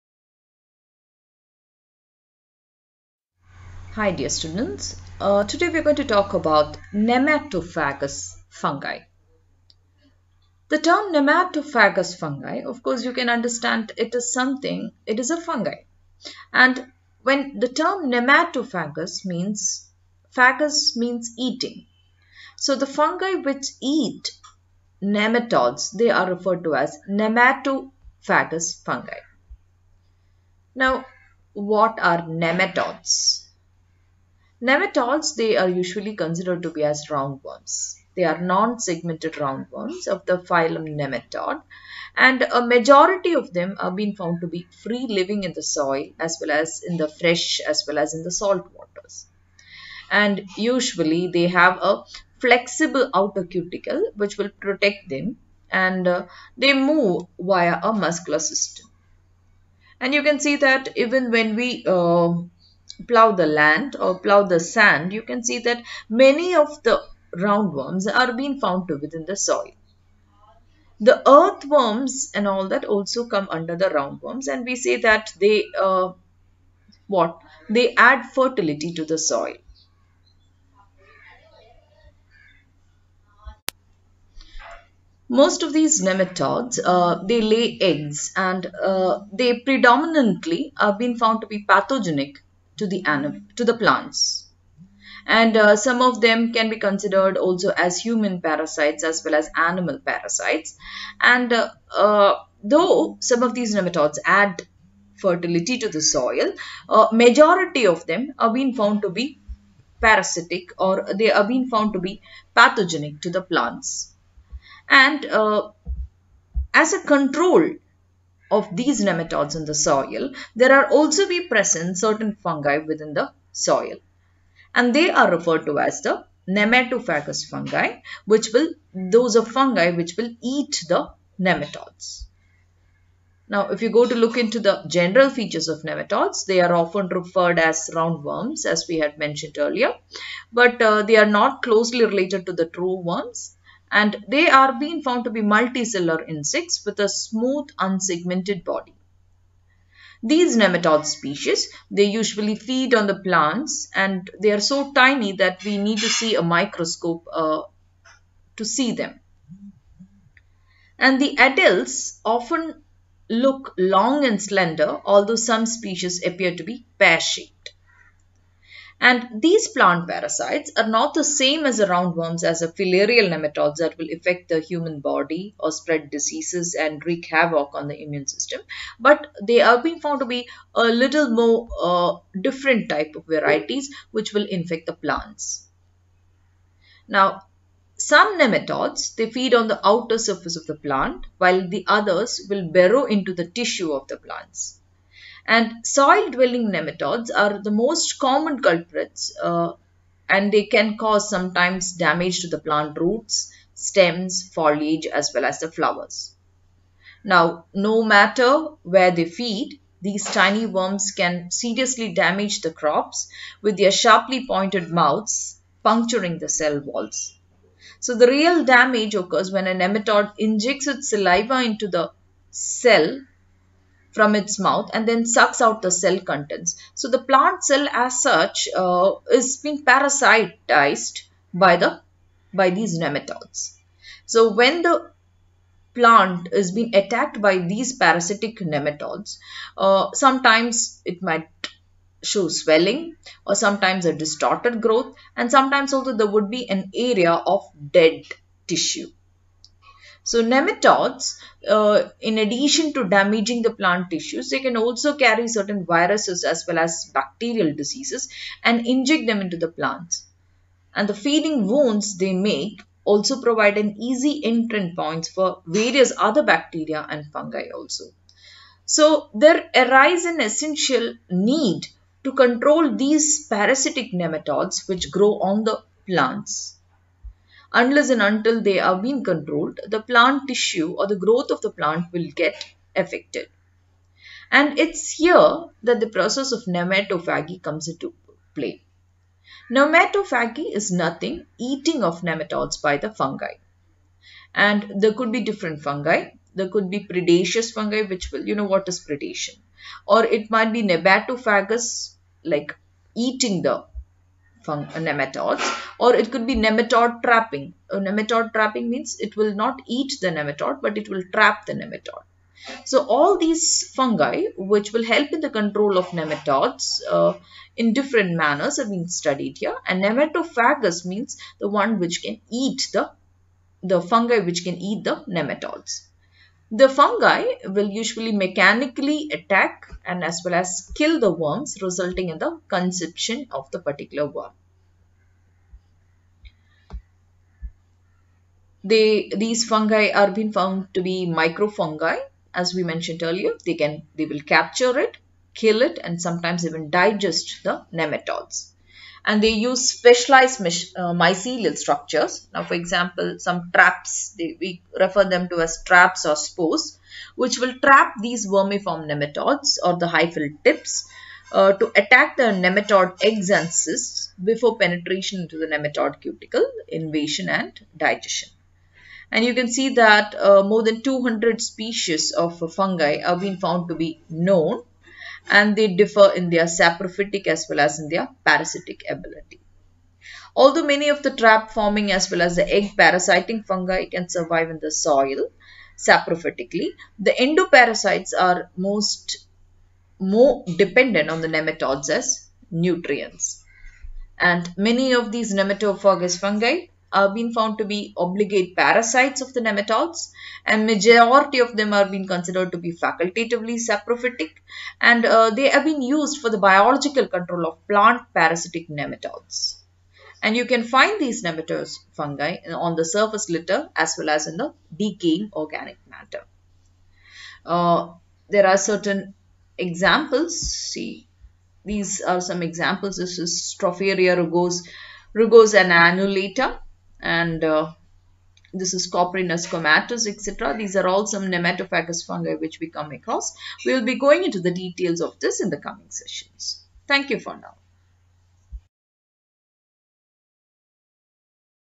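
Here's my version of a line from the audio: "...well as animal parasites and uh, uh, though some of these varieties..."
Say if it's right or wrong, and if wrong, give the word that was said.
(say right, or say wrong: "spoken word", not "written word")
wrong: "nematodes", not "varieties".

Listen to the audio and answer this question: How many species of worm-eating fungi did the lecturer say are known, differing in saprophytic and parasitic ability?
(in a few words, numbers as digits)
More than 200.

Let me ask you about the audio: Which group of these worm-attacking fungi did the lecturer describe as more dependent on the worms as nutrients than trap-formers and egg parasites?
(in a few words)
Endoparasites.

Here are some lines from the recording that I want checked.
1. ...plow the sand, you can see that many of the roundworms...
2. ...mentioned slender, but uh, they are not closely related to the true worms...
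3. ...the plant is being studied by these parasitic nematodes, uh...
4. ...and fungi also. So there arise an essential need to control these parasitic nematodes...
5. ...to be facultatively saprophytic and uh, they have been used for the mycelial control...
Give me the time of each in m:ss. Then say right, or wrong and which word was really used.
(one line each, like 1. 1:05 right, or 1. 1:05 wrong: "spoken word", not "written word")
1. 1:04 right
2. 2:19 wrong: "earlier", not "slender"
3. 3:54 wrong: "attacked", not "studied"
4. 4:27 right
5. 6:42 wrong: "biological", not "mycelial".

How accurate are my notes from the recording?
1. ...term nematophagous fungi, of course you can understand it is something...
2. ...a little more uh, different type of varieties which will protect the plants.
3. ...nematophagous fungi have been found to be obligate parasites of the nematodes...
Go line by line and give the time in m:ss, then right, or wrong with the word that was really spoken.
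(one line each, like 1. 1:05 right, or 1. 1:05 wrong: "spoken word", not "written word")
1. 0:10 right
2. 3:00 wrong: "infect", not "protect"
3. 6:35 right.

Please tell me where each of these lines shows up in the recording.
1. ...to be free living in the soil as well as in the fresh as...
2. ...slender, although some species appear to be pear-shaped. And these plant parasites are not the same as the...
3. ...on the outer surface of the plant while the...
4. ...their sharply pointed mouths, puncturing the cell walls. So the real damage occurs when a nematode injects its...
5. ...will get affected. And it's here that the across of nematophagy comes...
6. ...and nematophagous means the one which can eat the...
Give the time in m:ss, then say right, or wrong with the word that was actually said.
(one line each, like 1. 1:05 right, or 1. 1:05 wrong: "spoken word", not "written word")
1. 0:44 right
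2. 2:44 right
3. 3:09 right
4. 3:33 right
5. 4:42 wrong: "process", not "across"
6. 5:19 right.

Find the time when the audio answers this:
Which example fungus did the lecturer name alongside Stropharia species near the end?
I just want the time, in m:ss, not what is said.
7:09.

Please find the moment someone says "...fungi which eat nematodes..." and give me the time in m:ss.
0:22.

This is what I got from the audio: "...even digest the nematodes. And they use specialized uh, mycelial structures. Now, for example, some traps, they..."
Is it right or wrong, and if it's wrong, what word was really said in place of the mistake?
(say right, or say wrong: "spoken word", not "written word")
right.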